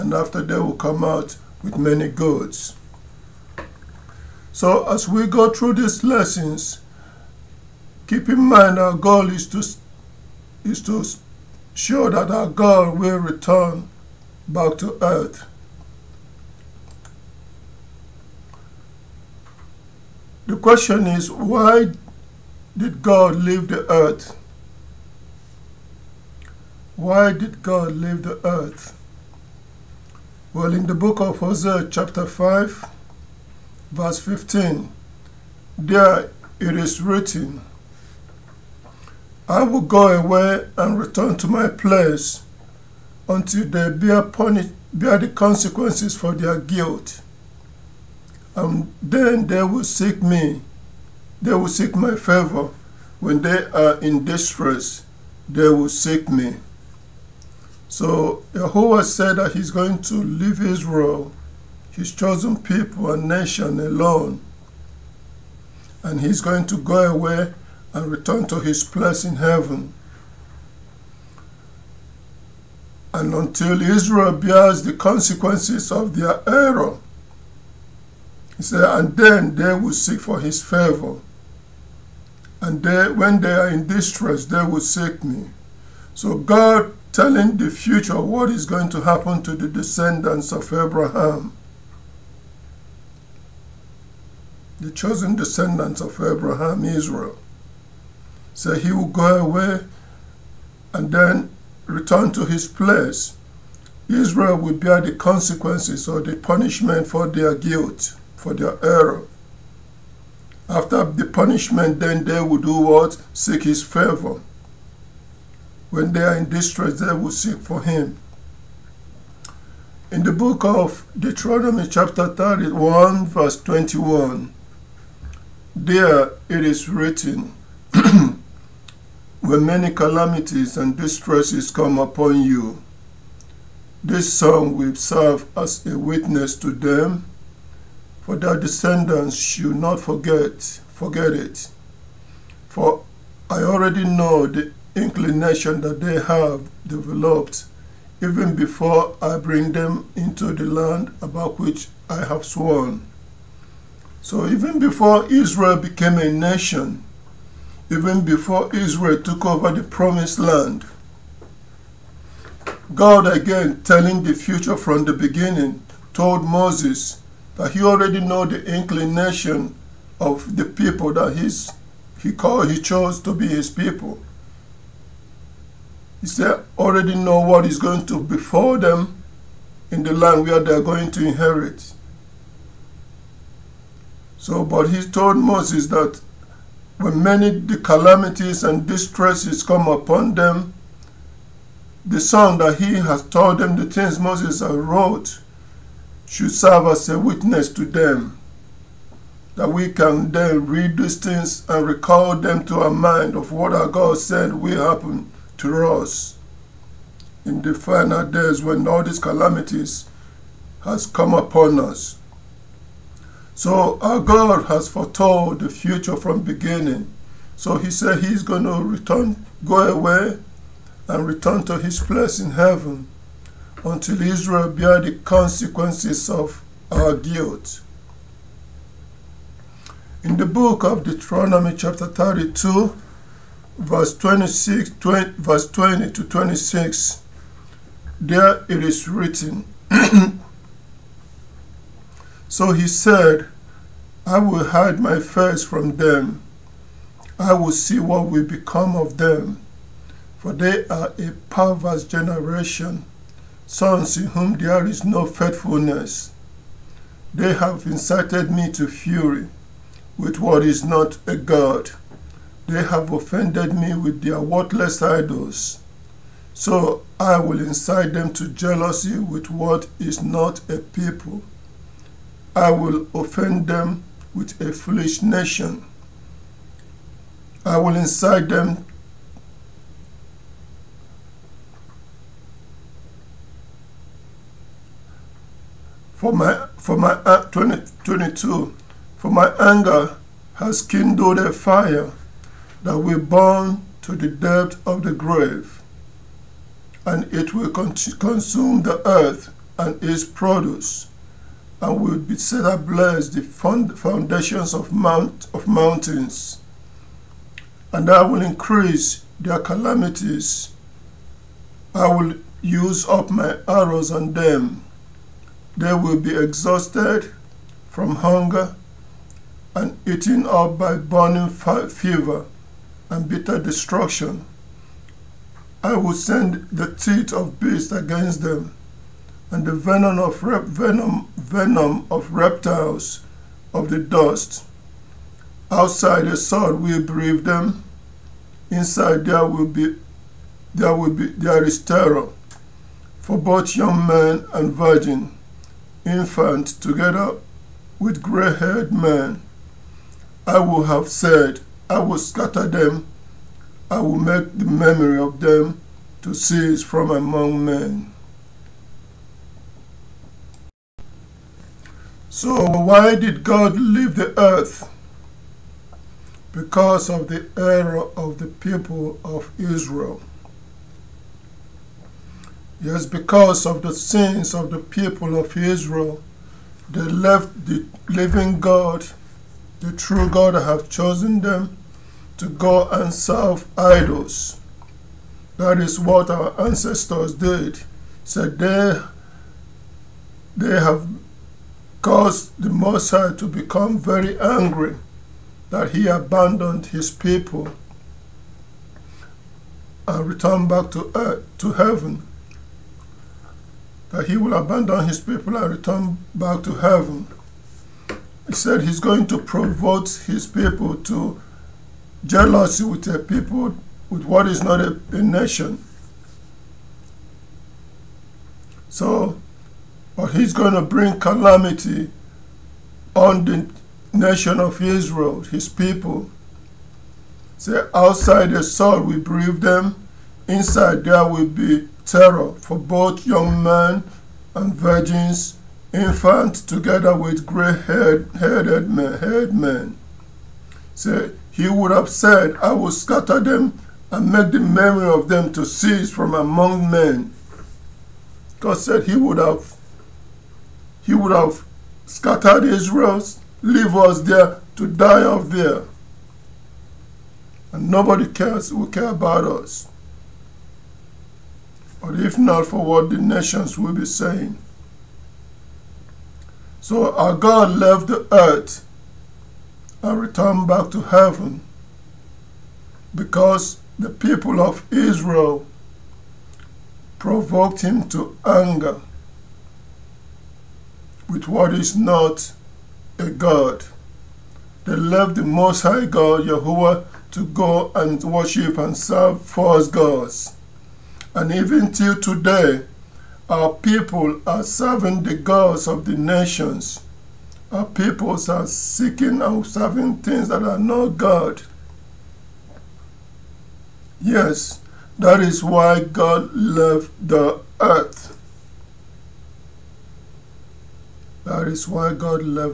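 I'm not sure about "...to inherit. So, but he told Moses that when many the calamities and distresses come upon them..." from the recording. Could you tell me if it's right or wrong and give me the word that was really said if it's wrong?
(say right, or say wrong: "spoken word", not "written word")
right.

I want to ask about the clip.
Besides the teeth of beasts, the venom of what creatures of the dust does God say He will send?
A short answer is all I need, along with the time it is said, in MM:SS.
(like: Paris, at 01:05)
reptiles, at 05:32.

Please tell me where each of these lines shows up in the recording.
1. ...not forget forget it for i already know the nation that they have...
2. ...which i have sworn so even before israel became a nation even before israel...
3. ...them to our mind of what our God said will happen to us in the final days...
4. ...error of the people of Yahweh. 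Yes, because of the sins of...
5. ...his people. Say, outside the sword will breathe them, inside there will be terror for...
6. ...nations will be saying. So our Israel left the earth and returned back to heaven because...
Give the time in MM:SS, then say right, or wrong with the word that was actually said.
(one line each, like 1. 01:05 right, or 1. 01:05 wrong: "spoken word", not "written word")
1. 02:19 wrong: "inclination", not "nation"
2. 02:31 right
3. 03:22 right
4. 06:07 wrong: "Israel", not "Yahweh"
5. 07:05 right
6. 07:43 wrong: "God", not "Israel".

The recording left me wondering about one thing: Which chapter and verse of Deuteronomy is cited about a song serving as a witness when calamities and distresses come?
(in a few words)
chapter 31, verse 21.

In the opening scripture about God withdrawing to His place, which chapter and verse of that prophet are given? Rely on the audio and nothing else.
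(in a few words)
chapter 5, verse 15.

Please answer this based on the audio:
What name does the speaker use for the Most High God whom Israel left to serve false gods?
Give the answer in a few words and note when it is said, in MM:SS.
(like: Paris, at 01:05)
Yahweh, at 08:06.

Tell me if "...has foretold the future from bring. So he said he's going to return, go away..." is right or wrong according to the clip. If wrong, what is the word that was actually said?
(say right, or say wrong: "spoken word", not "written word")
wrong: "beginning", not "bring".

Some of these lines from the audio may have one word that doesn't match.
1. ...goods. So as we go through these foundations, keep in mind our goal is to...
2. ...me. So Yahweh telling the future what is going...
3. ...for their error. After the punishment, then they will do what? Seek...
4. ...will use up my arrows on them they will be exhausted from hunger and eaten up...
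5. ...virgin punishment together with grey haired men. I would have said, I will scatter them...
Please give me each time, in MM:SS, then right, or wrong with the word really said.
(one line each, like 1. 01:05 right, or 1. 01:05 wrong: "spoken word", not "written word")
1. 00:02 wrong: "lessons", not "foundations"
2. 01:25 wrong: "God", not "Yahweh"
3. 01:48 right
4. 05:12 right
5. 05:44 wrong: "infant", not "punishment".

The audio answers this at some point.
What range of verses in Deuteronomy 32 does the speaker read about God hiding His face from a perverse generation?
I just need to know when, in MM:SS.
03:55.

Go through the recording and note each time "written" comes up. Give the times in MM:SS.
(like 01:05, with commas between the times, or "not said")
00:37, 02:06, 03:59.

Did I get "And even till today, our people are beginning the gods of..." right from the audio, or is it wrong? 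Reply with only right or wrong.
wrong.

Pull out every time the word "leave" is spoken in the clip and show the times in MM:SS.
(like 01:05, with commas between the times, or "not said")
00:23, 00:27, 01:00, 06:03, 07:33.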